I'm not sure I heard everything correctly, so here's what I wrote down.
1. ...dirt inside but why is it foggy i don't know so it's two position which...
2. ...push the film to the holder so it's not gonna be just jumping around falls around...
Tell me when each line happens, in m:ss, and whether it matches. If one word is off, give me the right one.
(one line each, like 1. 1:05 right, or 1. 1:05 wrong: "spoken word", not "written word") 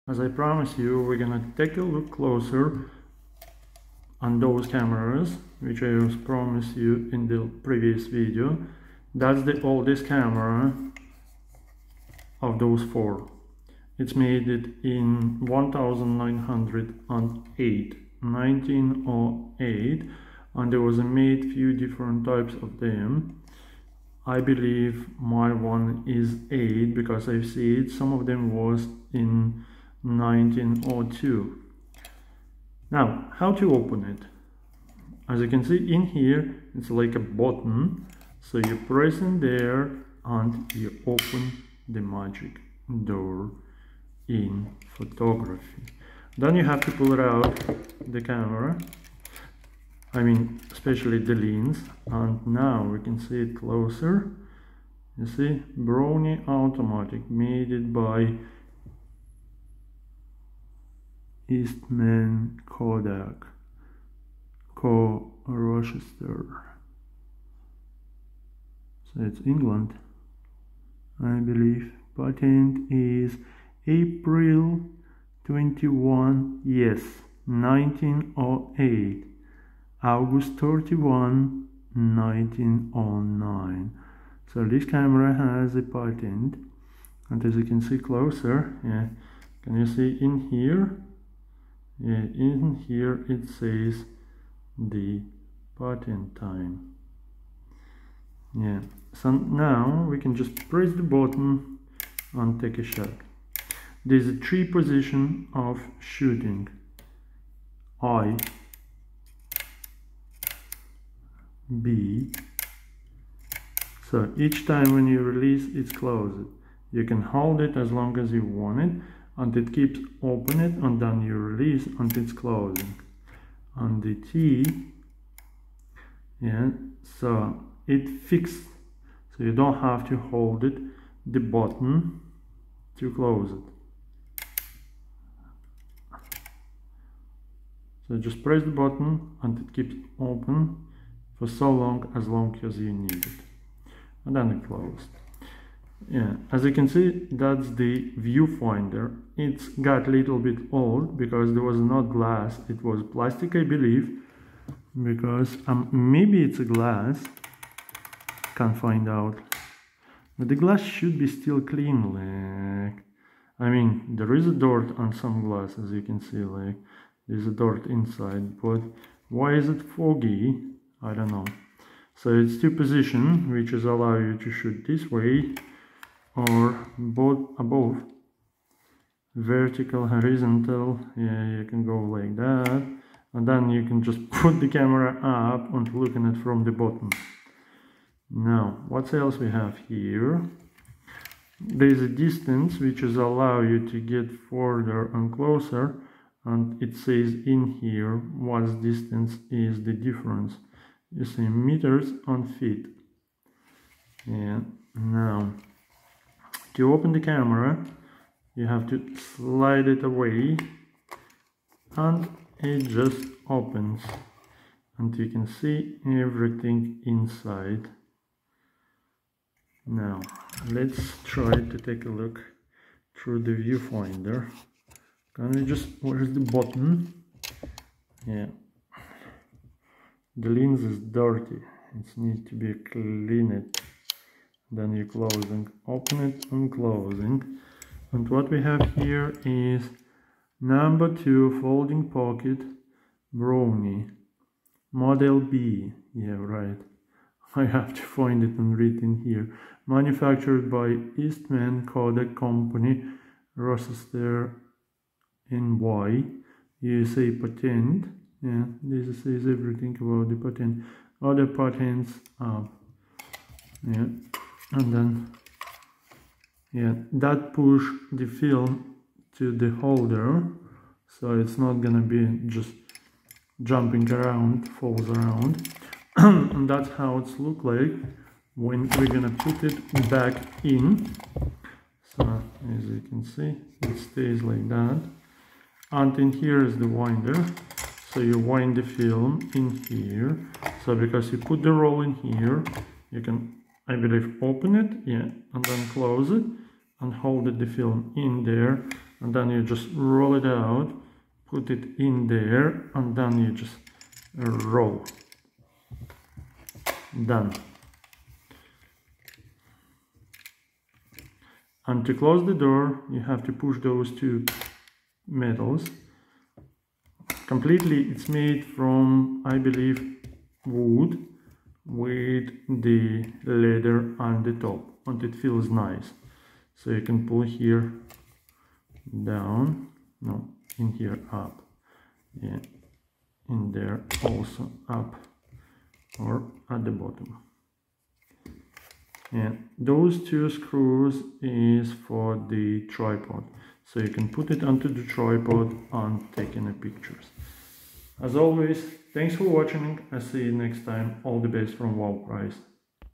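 1. 2:47 right
2. 4:27 right.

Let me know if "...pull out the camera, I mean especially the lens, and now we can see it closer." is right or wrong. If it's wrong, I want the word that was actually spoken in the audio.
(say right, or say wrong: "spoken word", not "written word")
right.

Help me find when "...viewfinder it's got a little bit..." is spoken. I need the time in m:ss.
2:28.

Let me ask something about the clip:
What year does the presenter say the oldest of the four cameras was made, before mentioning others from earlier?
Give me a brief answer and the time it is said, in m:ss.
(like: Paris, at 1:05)
1908, at 0:15.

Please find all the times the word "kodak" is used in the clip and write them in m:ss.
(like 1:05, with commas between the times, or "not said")
1:02, 4:11.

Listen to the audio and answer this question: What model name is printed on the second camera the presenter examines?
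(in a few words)
Number 2 Folding Pocket Brownie Model B.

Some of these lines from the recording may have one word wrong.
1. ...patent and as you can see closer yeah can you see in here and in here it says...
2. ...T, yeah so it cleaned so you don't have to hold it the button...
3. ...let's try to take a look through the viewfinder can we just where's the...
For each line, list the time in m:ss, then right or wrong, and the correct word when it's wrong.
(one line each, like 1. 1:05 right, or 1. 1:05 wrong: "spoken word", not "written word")
1. 1:25 right
2. 2:04 wrong: "fixed", not "cleaned"
3. 3:40 right.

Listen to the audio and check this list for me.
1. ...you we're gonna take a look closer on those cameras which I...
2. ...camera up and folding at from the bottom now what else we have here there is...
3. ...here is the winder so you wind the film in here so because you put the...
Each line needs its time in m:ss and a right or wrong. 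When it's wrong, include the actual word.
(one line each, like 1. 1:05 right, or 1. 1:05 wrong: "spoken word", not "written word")
1. 0:00 right
2. 3:04 wrong: "looking", not "folding"
3. 4:46 right.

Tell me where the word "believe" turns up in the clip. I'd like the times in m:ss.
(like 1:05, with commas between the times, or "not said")
0:24, 1:11, 2:33, 4:53, 5:19.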